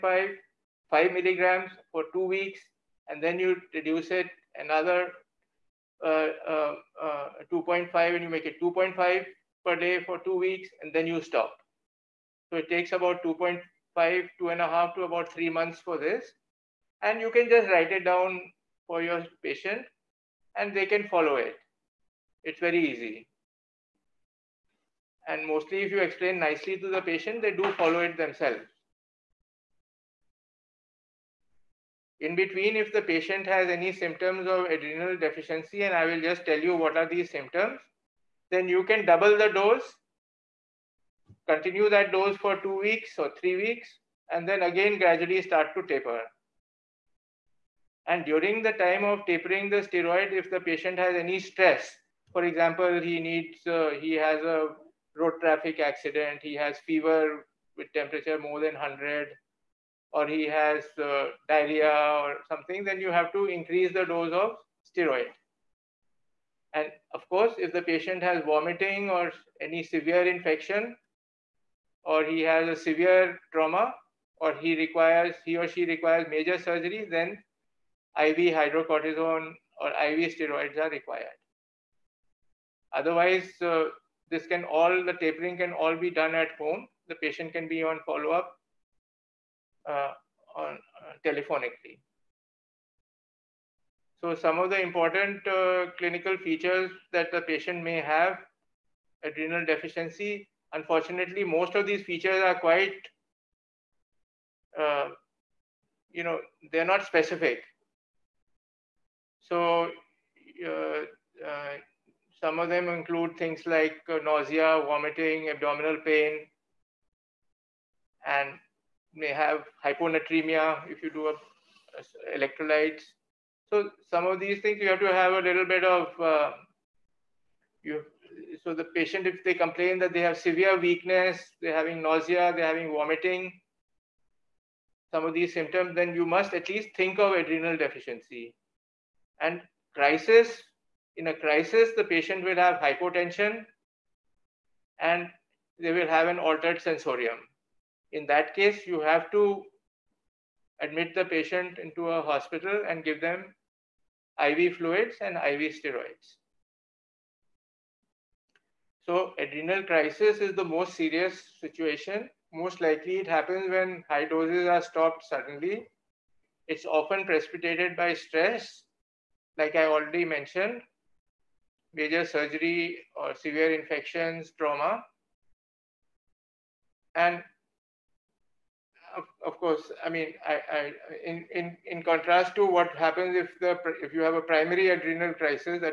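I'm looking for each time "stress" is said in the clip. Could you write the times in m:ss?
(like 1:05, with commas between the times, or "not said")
0:51, 2:48.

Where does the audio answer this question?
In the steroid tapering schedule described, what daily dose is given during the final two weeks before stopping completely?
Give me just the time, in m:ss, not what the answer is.
0:08.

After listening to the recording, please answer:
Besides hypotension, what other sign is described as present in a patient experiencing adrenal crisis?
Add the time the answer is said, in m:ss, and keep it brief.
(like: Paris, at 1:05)
Altered sensorium, at 2:26.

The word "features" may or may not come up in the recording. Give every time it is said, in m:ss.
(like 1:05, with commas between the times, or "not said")
1:36, 1:42.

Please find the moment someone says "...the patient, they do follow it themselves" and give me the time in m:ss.
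0:26.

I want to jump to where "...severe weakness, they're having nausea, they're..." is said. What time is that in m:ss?
2:10.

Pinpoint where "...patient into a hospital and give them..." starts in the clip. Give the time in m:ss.
2:31.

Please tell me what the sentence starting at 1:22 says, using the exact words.
Otherwise, uh, this can all, the tapering can all be done at home.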